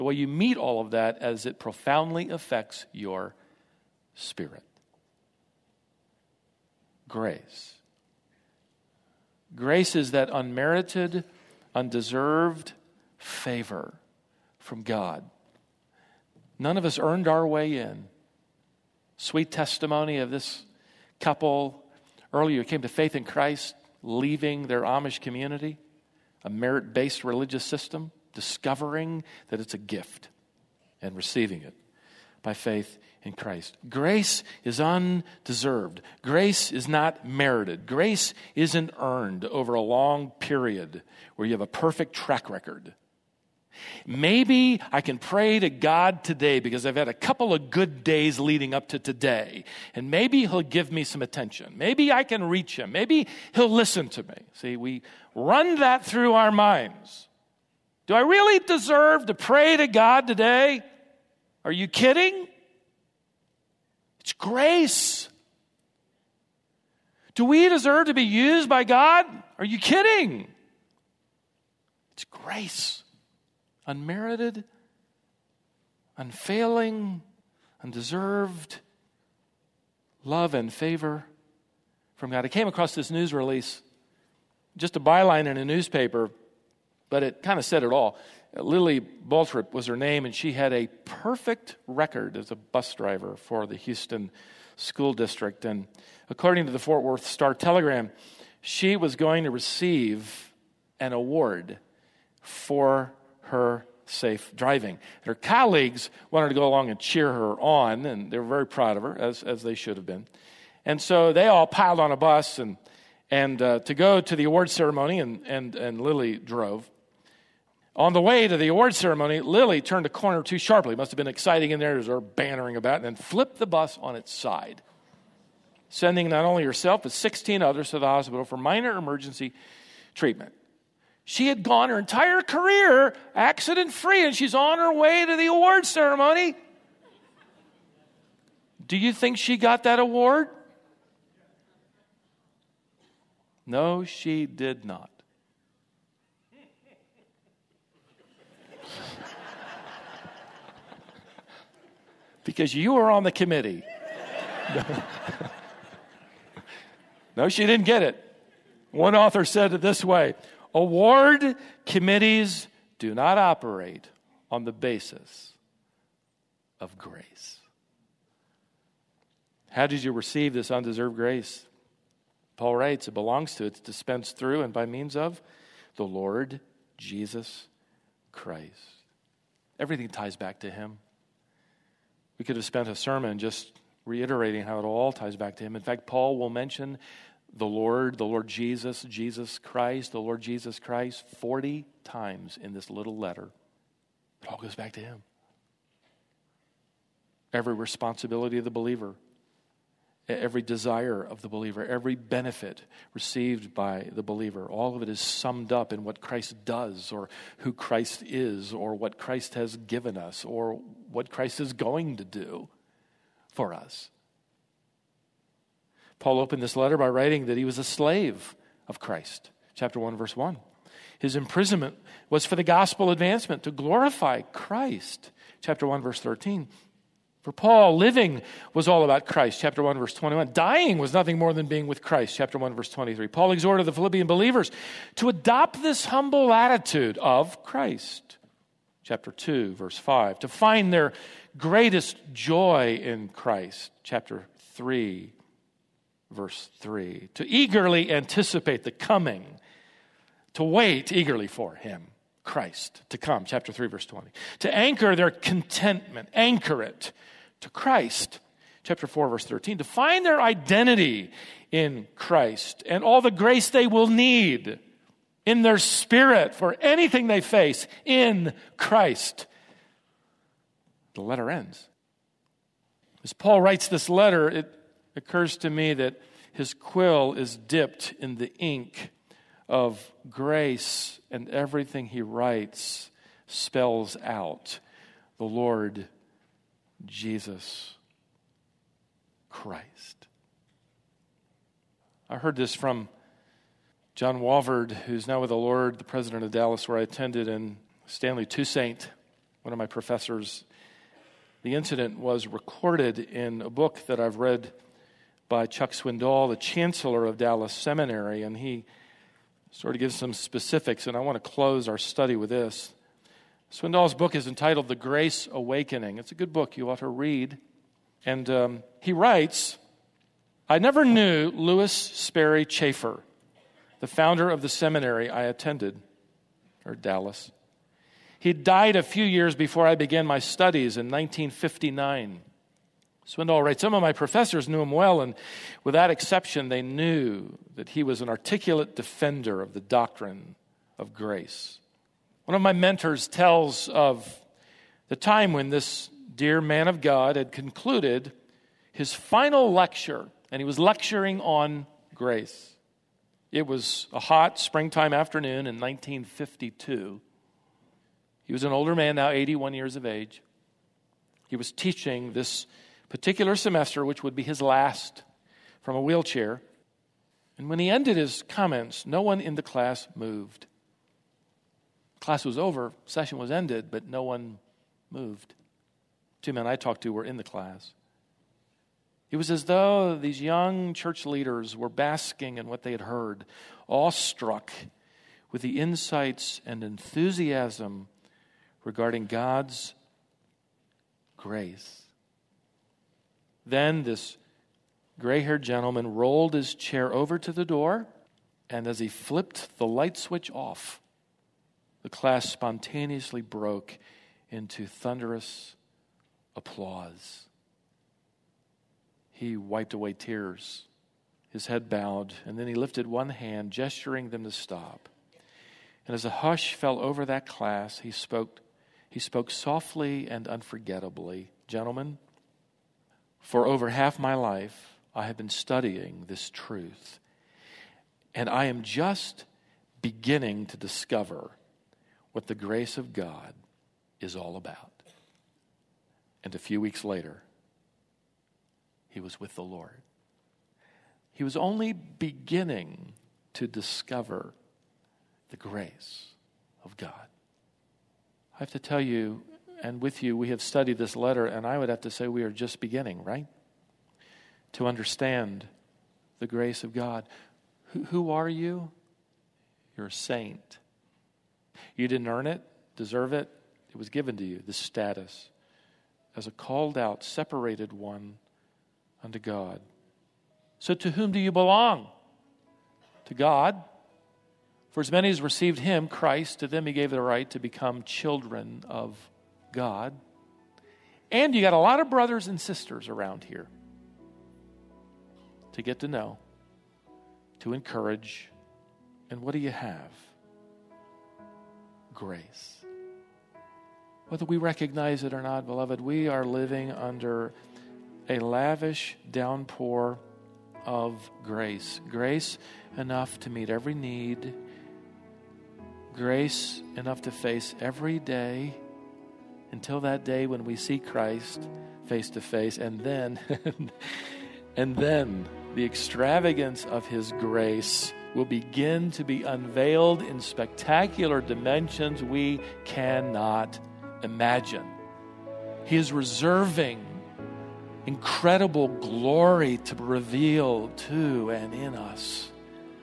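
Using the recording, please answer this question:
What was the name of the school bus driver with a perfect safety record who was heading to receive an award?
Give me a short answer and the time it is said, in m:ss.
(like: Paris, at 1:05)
Lily Balthrop, at 1:28.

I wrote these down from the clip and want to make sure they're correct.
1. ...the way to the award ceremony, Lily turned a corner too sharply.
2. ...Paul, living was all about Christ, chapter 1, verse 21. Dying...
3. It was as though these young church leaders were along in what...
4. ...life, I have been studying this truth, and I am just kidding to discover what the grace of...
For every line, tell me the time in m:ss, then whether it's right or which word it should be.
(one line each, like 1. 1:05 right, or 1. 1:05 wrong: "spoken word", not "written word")
1. 1:58 right
2. 3:47 right
3. 6:19 wrong: "basking", not "along"
4. 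7:04 wrong: "beginning", not "kidding".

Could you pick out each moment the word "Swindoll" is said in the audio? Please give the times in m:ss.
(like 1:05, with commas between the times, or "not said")
5:05, 5:13, 5:33.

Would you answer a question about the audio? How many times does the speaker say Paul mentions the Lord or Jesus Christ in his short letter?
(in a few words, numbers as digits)
40.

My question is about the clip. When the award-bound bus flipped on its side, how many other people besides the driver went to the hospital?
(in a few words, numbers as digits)
16.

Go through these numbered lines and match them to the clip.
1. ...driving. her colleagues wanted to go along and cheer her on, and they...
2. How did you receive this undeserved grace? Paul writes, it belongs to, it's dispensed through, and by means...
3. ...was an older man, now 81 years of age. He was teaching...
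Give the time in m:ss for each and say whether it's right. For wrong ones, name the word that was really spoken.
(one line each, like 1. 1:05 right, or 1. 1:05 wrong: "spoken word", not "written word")
1. 1:44 right
2. 2:49 right
3. 5:58 right.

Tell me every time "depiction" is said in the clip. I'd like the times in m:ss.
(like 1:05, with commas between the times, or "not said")
not said.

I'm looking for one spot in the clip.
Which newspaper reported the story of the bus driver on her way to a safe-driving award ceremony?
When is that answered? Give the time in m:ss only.
1:36.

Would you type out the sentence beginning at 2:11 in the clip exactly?
She had gone her entire career accident free, and she's on her way to the award ceremony.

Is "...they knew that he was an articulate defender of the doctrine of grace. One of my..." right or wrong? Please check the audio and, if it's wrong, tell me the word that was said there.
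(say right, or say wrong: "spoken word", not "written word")
right.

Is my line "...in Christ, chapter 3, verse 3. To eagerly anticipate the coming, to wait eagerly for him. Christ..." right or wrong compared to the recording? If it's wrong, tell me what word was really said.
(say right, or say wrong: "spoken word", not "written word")
right.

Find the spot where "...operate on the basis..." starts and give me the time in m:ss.
2:43.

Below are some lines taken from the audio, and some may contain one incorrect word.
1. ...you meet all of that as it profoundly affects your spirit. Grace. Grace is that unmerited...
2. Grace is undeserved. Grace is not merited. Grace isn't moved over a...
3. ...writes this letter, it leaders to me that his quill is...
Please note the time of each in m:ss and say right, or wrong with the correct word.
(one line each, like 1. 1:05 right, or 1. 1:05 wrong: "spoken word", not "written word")
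1. 0:00 right
2. 0:33 wrong: "earned", not "moved"
3. 4:33 wrong: "occurs", not "leaders".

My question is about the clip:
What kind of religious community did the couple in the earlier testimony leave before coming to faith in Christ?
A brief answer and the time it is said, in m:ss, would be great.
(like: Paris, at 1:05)
Amish, at 0:24.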